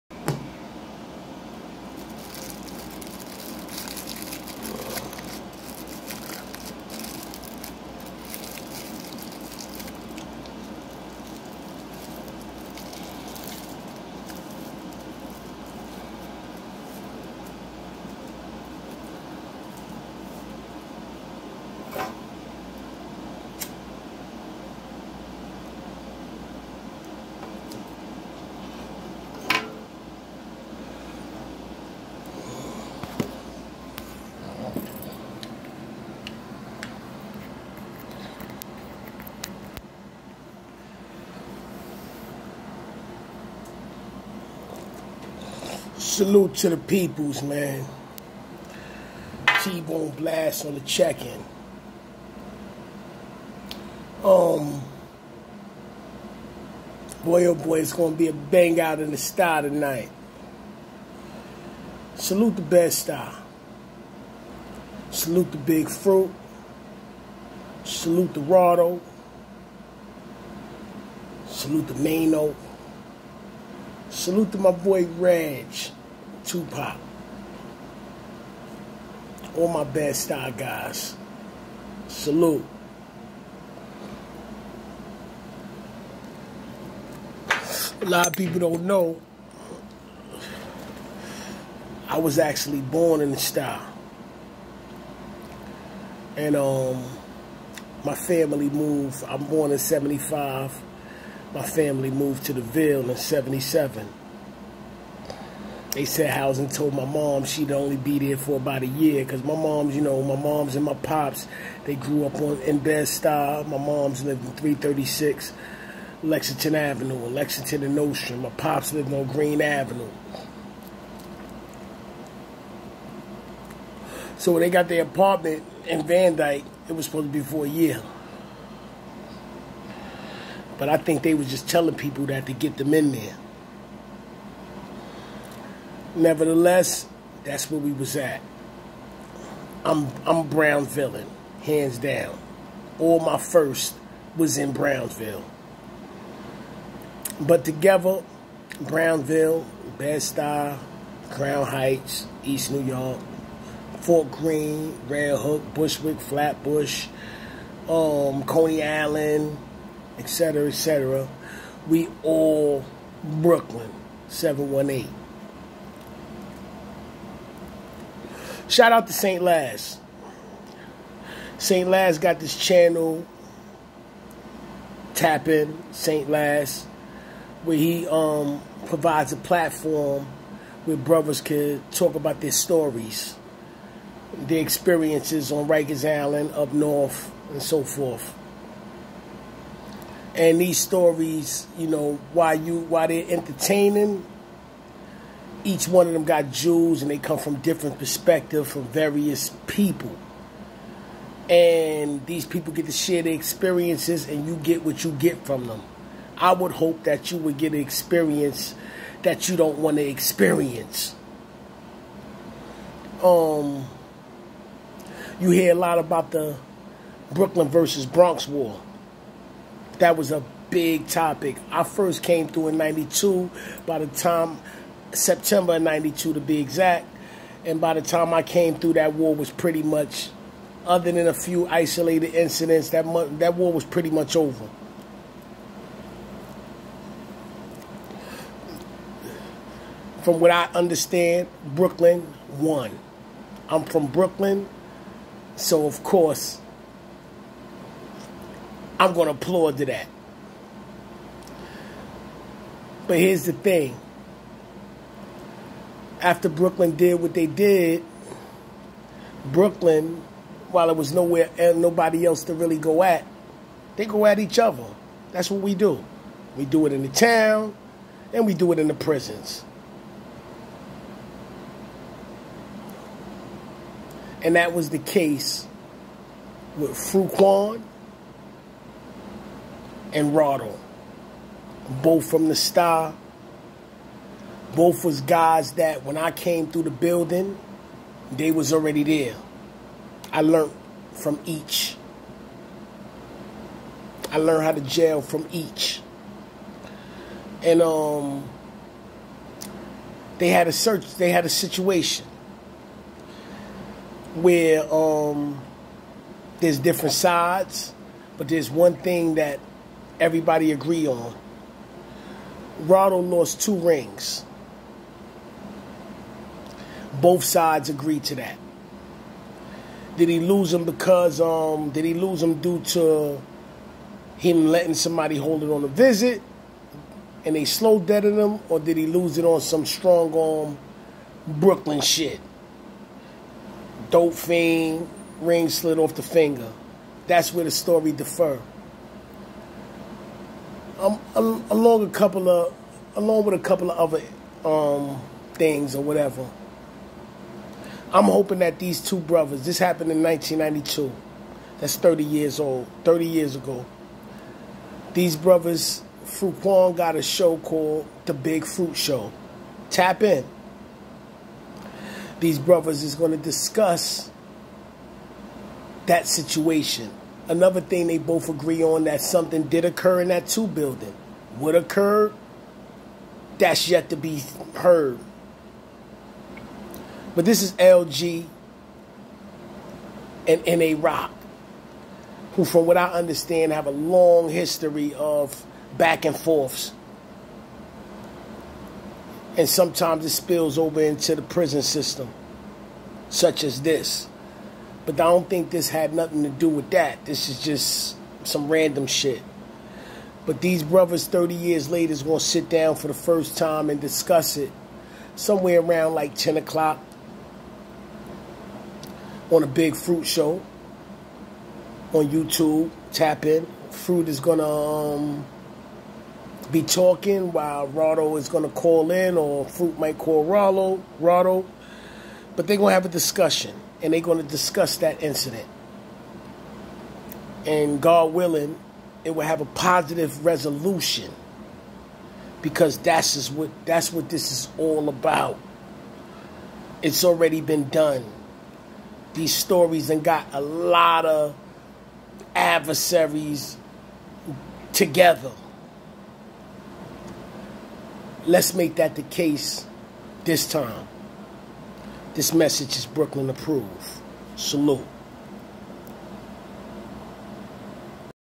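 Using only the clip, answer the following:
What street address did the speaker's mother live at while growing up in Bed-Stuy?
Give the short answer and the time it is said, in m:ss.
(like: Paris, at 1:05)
336 Lexington Avenue, at 1:54.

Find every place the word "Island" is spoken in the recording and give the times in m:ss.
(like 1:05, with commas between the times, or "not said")
2:38, 3:06.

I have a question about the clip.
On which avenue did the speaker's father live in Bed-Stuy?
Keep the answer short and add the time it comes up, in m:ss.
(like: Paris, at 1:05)
Greene Avenue, at 1:59.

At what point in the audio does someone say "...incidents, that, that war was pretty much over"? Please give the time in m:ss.
3:52.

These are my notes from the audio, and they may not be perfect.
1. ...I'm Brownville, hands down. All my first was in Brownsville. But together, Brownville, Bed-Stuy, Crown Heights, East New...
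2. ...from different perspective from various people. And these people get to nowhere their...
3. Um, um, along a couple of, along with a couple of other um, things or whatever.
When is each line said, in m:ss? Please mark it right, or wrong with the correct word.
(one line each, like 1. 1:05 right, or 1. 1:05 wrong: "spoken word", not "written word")
1. 2:20 right
2. 3:17 wrong: "share", not "nowhere"
3. 5:40 right.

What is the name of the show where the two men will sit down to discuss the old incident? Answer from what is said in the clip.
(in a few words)
The Big Fruit Show.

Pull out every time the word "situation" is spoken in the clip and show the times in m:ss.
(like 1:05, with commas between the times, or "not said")
5:01, 6:06.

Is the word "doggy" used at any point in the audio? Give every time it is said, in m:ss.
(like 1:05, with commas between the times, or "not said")
not said.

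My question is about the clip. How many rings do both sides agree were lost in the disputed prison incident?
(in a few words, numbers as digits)
2.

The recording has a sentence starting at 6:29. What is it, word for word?
And sometimes it spills over into the prison system, such as this.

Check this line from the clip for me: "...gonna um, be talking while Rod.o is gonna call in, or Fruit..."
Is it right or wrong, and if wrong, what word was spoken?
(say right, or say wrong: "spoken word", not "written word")
right.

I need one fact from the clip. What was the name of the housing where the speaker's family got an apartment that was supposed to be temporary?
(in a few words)
Van Dyke.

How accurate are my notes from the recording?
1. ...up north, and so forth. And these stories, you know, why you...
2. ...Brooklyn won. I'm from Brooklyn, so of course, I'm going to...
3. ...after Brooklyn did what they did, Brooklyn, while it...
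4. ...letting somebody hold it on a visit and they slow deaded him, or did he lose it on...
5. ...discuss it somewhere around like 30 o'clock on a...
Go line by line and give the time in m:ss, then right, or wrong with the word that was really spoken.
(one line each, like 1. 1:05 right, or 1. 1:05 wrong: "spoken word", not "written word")
1. 3:06 right
2. 4:01 right
3. 4:16 right
4. 5:24 right
5. 6:44 wrong: "10", not "30".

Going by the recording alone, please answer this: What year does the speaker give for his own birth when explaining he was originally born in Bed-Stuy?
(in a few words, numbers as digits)
1975.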